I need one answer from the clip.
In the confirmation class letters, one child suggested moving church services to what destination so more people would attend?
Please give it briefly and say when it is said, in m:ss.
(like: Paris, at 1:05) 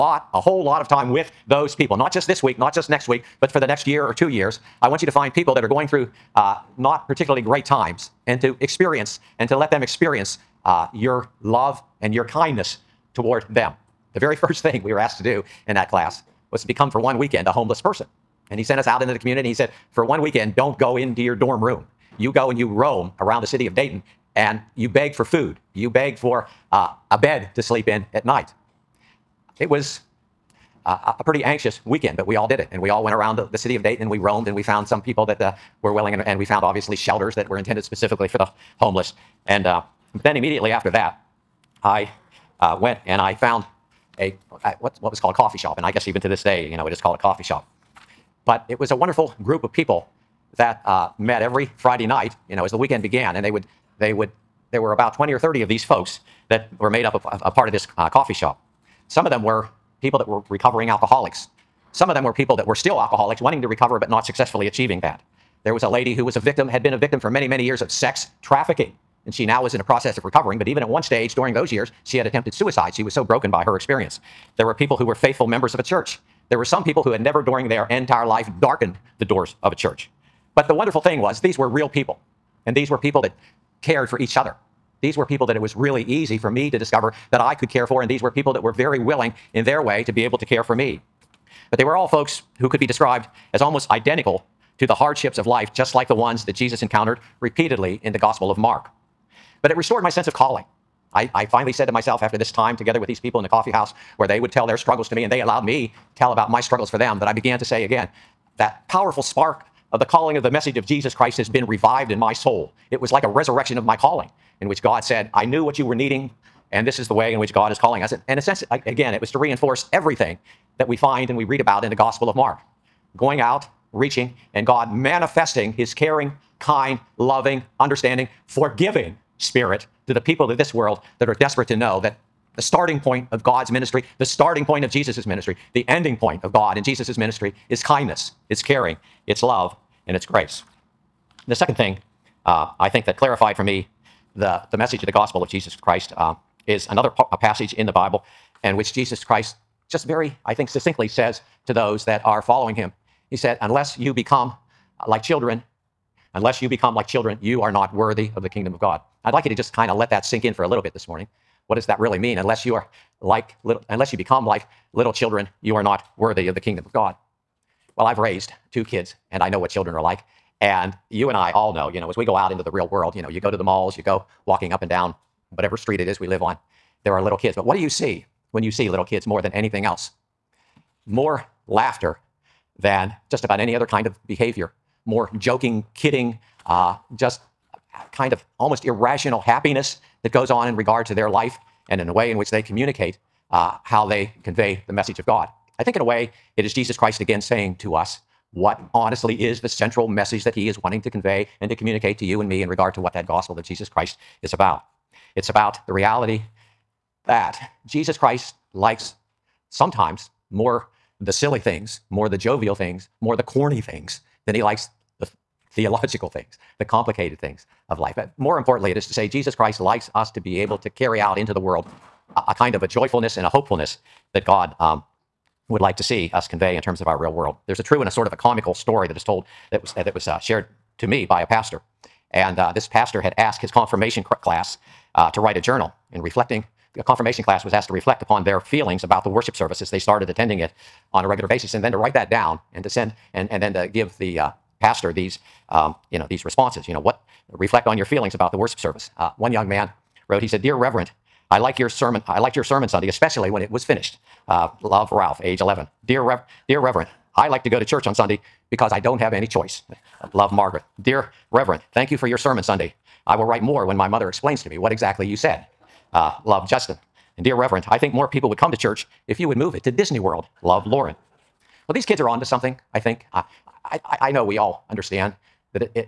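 Disney World, at 4:29.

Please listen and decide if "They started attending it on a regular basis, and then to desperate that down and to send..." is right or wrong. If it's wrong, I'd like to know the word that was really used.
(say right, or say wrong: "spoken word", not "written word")
wrong: "write", not "desperate".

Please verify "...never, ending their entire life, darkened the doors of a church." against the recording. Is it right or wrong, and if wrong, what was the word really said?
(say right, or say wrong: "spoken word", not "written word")
wrong: "during", not "ending".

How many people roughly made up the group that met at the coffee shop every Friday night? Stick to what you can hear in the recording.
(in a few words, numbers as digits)
20 or 30.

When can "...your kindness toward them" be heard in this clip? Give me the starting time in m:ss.
0:12.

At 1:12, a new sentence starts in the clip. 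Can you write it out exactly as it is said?
She was so broken by her experience.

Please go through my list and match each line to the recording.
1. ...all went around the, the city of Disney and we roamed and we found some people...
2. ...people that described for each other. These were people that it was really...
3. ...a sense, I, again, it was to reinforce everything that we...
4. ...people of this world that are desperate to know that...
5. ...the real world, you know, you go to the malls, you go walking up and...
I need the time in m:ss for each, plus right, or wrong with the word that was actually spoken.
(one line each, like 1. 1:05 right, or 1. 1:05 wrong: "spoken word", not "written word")
1. 0:32 wrong: "Dayton", not "Disney"
2. 1:22 wrong: "cared", not "described"
3. 1:58 right
4. 2:10 right
5. 2:52 right.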